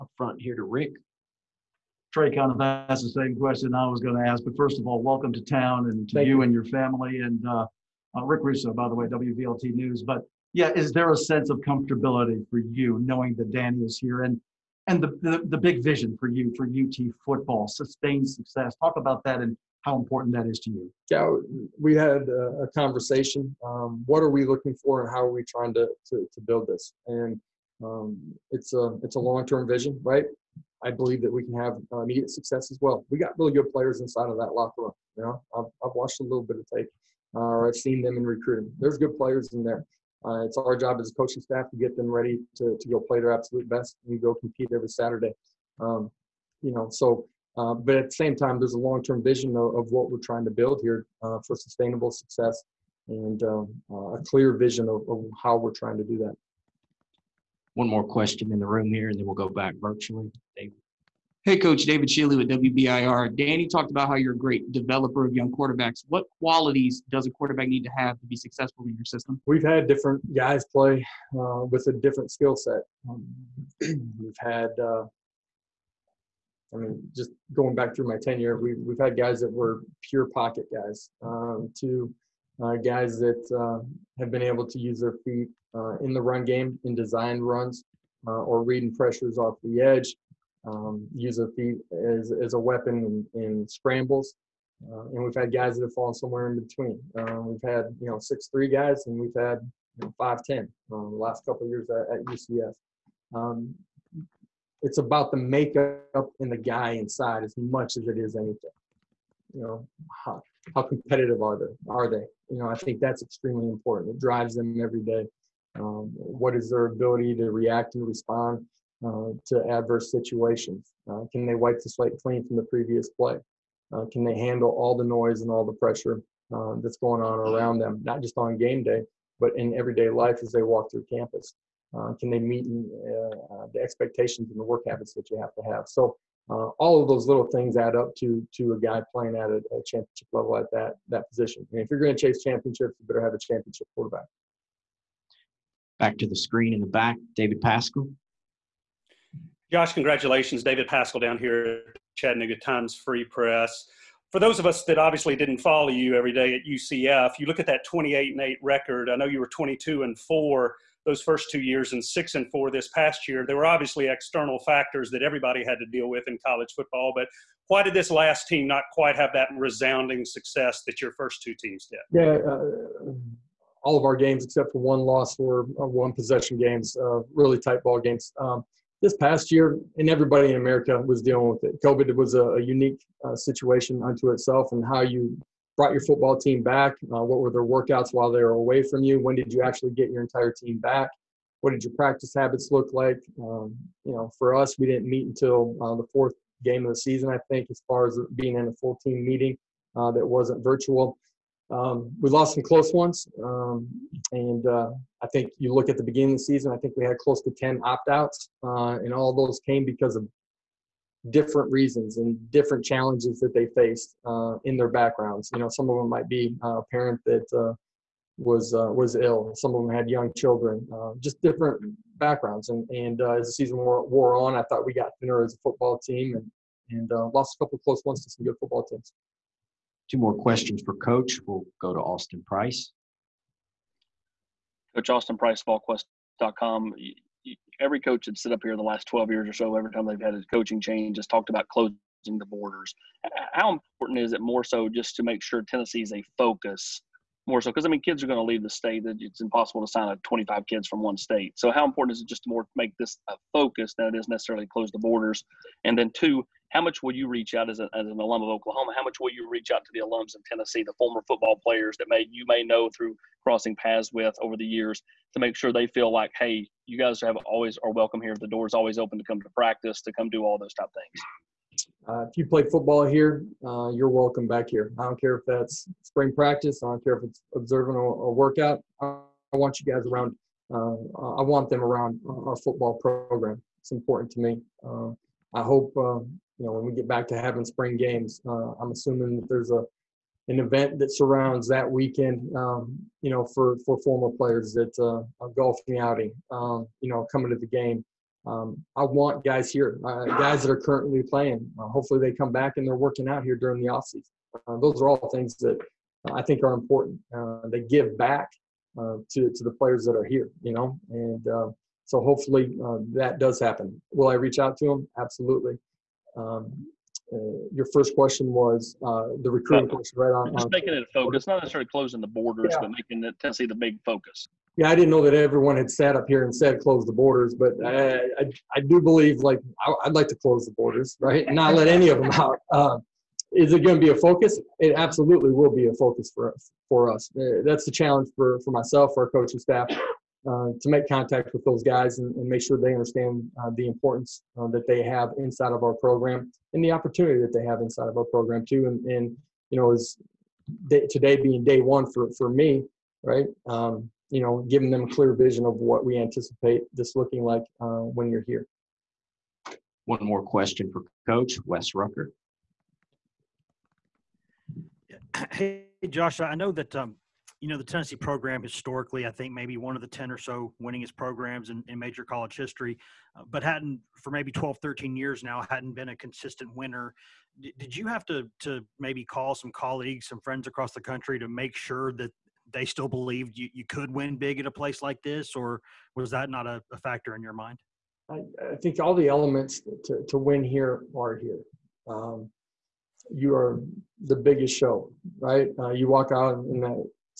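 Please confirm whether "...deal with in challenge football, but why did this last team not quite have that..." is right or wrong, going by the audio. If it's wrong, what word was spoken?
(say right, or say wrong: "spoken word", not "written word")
wrong: "college", not "challenge".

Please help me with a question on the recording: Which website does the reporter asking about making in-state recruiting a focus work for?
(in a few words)
VolQuest.com.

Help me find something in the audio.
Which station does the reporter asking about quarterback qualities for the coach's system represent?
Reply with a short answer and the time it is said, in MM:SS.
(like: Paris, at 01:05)
WBIR, at 01:02.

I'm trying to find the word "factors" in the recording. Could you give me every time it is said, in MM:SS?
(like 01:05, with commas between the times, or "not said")
02:44, 06:26.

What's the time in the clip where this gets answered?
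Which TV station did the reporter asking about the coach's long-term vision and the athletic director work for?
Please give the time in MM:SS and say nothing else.
00:09.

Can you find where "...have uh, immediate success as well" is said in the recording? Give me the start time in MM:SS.
00:31.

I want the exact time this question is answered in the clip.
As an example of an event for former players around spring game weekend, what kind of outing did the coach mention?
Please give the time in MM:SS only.
04:55.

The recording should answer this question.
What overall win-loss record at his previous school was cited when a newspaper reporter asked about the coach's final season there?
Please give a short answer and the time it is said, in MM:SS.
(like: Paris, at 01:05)
28 and 8, at 02:37.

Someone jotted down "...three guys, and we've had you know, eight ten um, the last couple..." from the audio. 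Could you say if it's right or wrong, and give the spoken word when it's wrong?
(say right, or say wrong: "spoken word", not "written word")
wrong: "five", not "eight".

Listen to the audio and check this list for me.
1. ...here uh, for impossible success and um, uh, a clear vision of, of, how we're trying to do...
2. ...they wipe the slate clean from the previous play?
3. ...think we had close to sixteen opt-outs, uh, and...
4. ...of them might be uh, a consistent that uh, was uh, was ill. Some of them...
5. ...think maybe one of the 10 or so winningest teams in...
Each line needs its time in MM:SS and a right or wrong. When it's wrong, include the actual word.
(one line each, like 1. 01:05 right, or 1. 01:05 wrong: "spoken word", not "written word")
1. 00:50 wrong: "sustainable", not "impossible"
2. 02:01 right
3. 03:26 wrong: "ten", not "sixteen"
4. 03:35 wrong: "parent", not "consistent"
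5. 06:09 wrong: "programs", not "teams".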